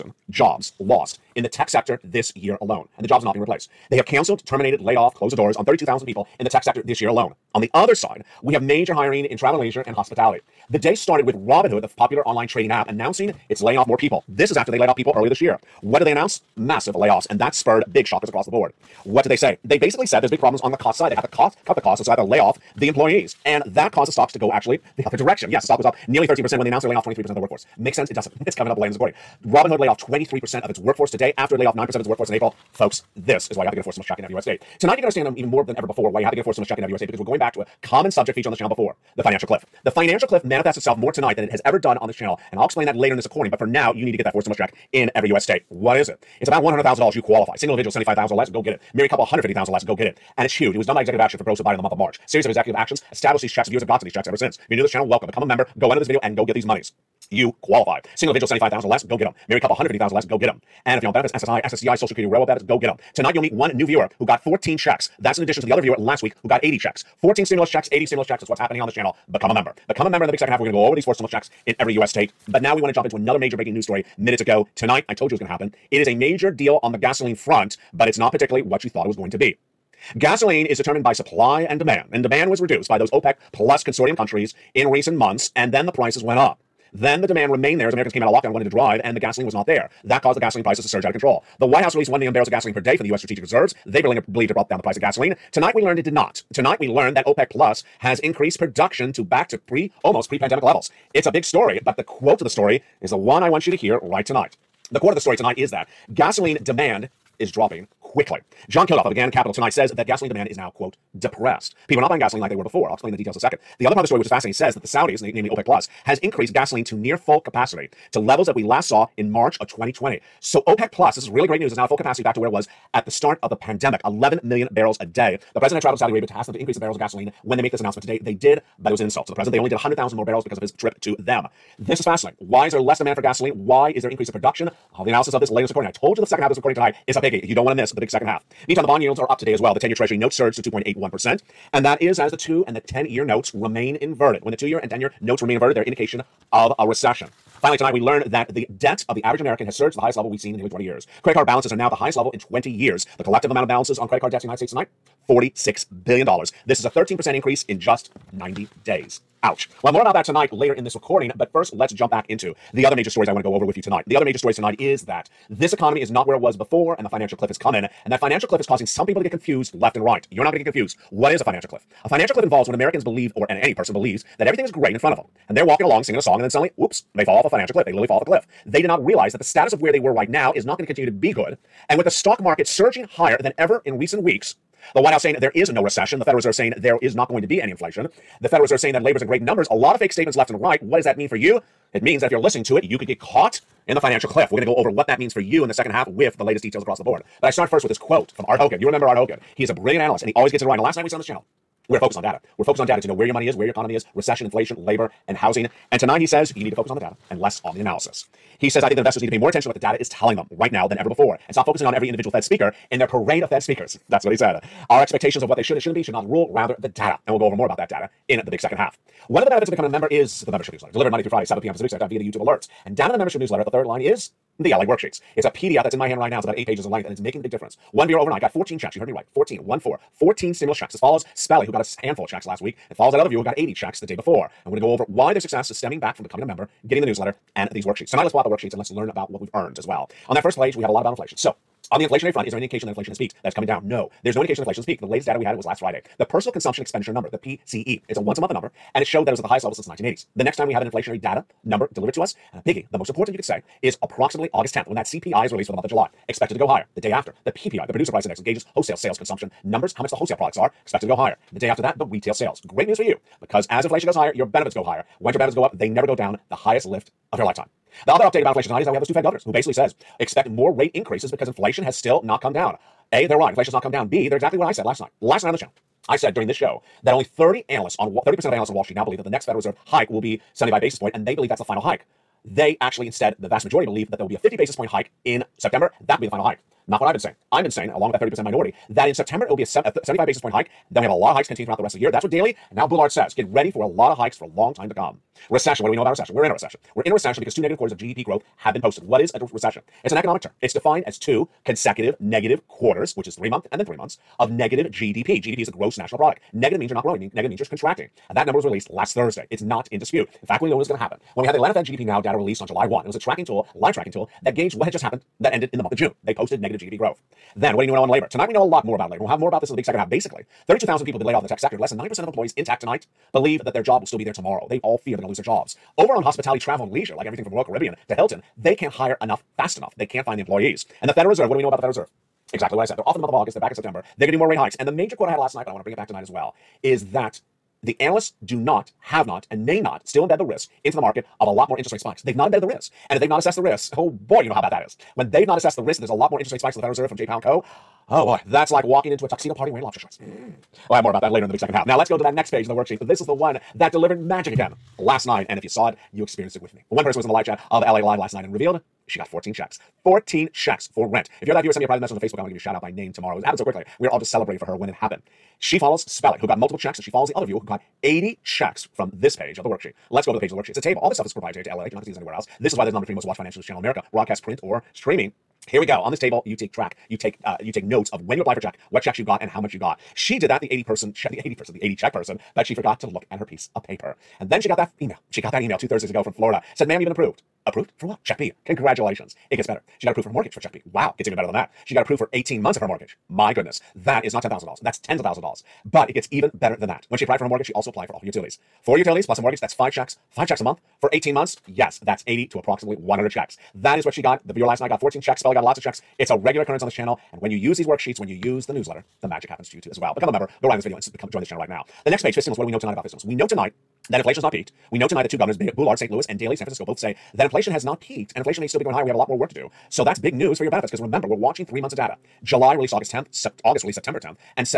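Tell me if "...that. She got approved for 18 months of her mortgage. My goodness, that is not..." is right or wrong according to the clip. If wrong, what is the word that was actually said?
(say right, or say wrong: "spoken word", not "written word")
right.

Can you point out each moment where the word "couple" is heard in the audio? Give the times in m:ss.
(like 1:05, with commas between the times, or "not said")
0:49, 0:59.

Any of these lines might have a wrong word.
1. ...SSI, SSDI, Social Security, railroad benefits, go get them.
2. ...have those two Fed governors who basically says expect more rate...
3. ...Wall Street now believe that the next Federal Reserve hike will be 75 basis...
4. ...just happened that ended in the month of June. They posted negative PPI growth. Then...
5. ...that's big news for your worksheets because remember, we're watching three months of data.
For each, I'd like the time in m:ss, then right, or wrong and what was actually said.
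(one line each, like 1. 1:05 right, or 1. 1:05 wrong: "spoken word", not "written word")
1. 1:01 right
2. 4:28 right
3. 4:38 right
4. 5:14 wrong: "GDP", not "PPI"
5. 7:00 wrong: "benefits", not "worksheets".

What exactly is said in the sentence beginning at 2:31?
Credit card balances are now at the highest level in 20 years.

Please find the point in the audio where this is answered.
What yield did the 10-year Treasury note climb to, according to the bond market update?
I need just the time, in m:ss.
2:20.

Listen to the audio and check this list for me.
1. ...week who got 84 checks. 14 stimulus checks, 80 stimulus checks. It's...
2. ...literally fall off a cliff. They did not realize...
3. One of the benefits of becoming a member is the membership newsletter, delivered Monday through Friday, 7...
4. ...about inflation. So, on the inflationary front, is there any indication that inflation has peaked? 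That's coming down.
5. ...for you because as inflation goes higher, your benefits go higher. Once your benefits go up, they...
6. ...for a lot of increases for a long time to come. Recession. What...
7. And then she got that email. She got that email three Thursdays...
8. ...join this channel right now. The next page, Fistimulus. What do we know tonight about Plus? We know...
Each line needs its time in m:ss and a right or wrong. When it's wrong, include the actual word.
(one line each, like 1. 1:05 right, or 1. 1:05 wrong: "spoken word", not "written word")
1. 1:06 wrong: "80", not "84"
2. 2:57 right
3. 3:39 right
4. 4:01 right
5. 4:22 right
6. 4:53 wrong: "hikes", not "increases"
7. 6:24 wrong: "two", not "three"
8. 6:51 wrong: "Fistimulus", not "Plus".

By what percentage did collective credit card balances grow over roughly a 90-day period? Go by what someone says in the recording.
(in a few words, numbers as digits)
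13%.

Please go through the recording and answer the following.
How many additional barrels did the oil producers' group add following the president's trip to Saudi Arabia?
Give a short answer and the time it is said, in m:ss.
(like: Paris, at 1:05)
100,000, at 2:09.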